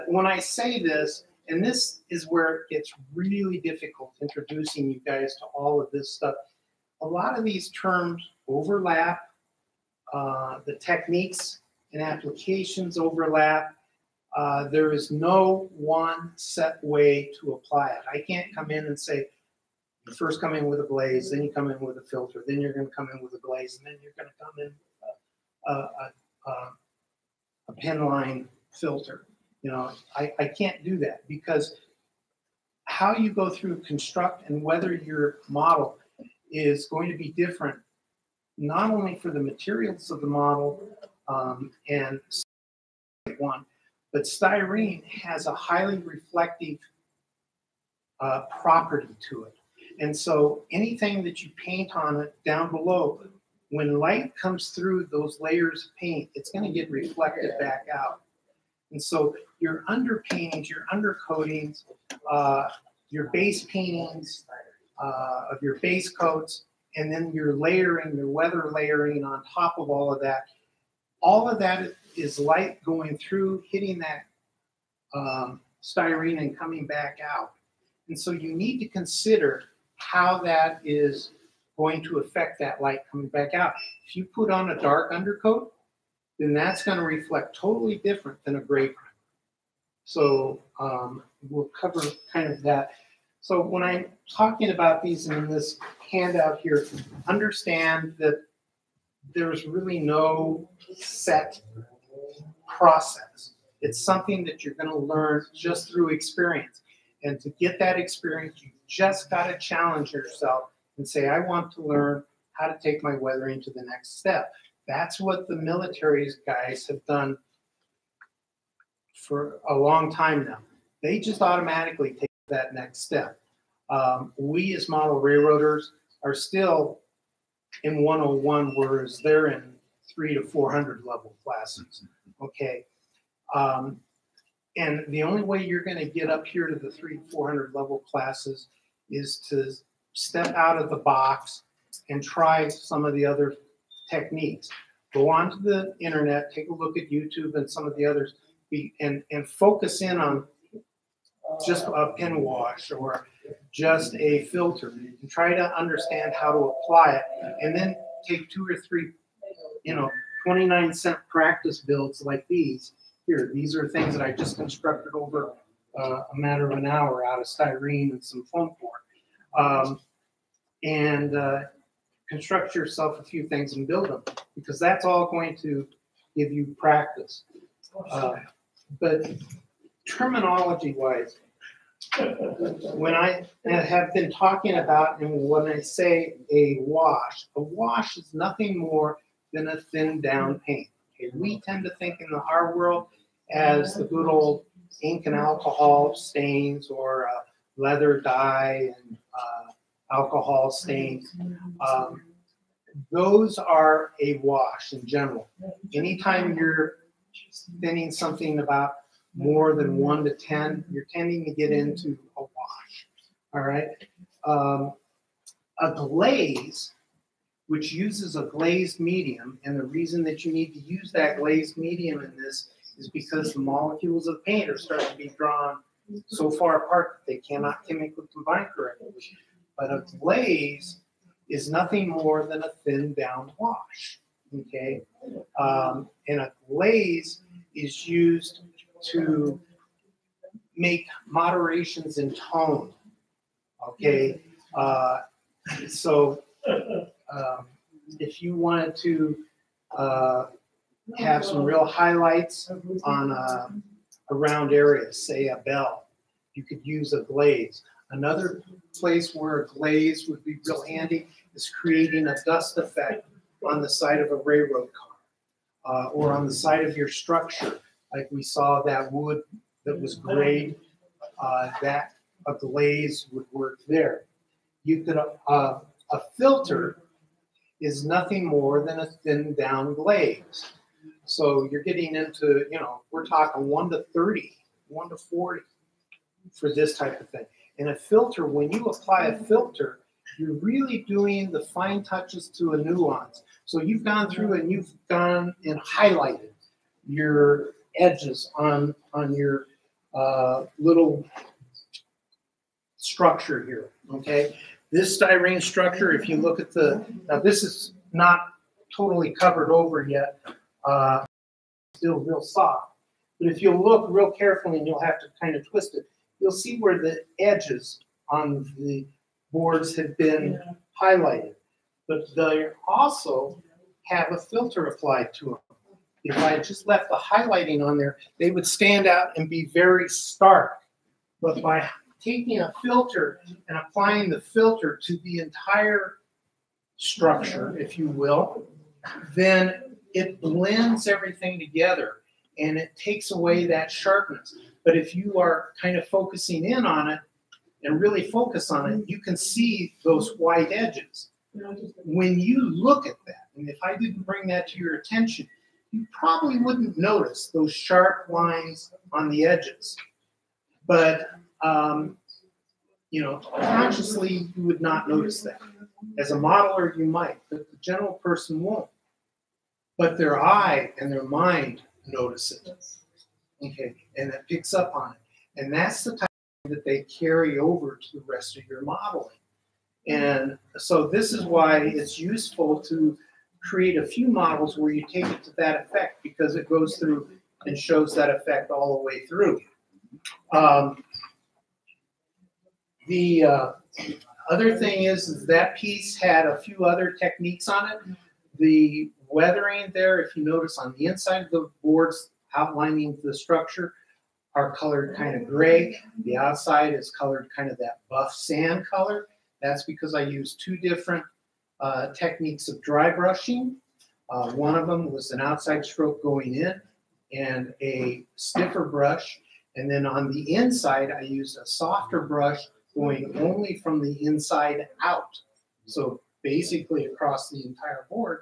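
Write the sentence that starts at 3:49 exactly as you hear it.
But a glaze is nothing more than a thin down wash.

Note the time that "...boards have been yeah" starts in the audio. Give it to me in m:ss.
5:19.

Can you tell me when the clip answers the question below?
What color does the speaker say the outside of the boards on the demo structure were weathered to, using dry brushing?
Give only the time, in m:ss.
6:48.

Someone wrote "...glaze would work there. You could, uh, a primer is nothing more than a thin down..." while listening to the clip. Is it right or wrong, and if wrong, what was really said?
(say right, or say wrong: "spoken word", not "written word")
wrong: "filter", not "primer".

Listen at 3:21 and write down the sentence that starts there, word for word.
Um, those are a wash in general.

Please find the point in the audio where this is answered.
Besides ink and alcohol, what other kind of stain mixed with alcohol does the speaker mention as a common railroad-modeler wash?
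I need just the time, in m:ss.
3:17.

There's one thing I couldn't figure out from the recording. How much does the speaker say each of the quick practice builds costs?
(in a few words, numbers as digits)
29 cents.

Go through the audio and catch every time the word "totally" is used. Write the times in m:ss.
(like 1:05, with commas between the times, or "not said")
1:27, 5:08.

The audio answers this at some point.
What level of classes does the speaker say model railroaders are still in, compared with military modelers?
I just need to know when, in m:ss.
2:08.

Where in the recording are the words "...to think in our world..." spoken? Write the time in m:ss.
3:11.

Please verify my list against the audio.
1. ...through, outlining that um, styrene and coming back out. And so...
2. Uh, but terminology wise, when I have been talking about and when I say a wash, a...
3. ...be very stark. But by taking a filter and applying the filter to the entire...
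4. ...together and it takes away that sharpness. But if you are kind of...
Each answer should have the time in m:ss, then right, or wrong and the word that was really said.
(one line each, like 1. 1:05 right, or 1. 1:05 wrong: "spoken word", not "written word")
1. 1:13 wrong: "hitting", not "outlining"
2. 2:58 right
3. 5:29 right
4. 5:41 right.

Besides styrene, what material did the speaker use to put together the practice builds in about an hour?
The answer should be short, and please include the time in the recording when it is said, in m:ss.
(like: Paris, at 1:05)
foam board, at 2:48.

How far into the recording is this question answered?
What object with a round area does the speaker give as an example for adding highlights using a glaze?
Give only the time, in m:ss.
4:15.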